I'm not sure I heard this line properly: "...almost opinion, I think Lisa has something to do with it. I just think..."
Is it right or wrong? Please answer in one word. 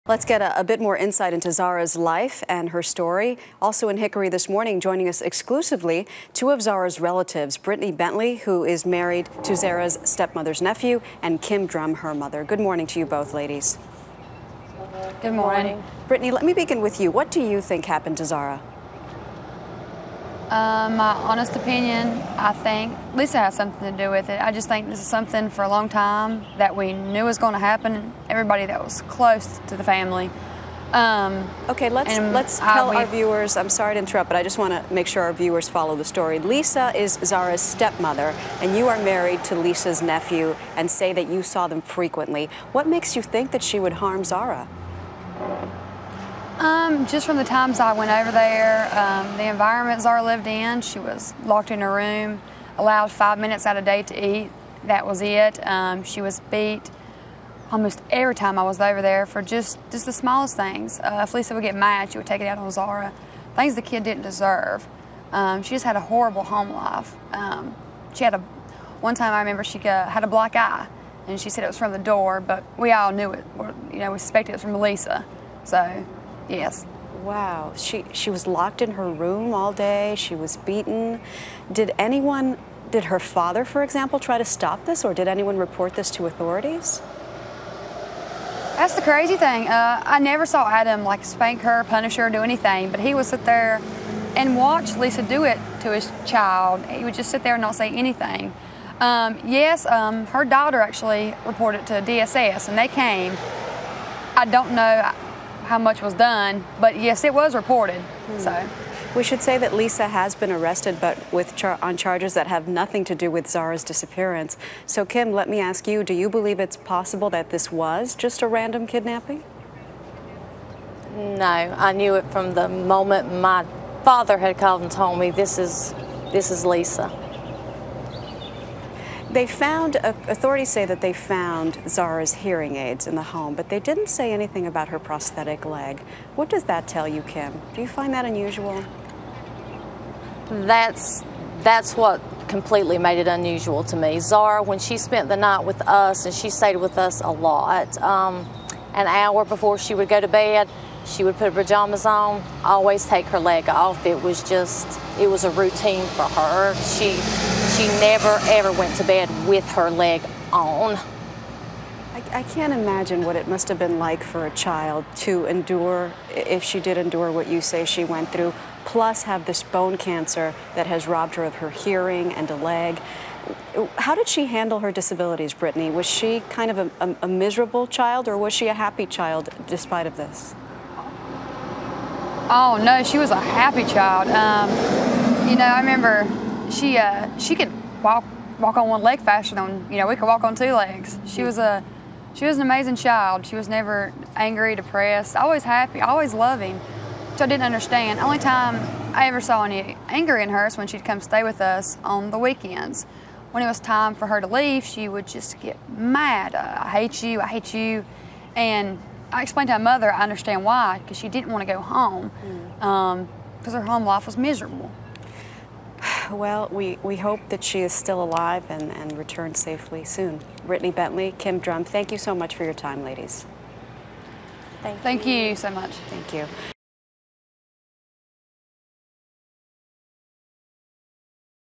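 wrong.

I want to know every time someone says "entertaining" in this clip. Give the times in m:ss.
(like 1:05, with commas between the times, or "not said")
not said.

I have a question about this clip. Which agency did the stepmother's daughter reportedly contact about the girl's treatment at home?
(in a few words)
DSS.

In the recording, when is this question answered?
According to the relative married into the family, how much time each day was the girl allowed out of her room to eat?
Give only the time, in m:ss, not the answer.
0:53.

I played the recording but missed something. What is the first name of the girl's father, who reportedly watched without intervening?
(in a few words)
Adam.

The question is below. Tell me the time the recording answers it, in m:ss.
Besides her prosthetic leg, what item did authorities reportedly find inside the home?
2:12.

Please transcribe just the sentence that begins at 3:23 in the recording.
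When it was time for her to leave, she would just get mad.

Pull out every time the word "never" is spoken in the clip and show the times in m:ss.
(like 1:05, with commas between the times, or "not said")
1:30, 2:37, 3:13.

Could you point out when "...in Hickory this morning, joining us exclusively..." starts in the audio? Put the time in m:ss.
0:03.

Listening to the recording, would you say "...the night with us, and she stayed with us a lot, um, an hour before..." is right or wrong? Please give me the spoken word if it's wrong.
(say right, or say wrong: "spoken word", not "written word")
right.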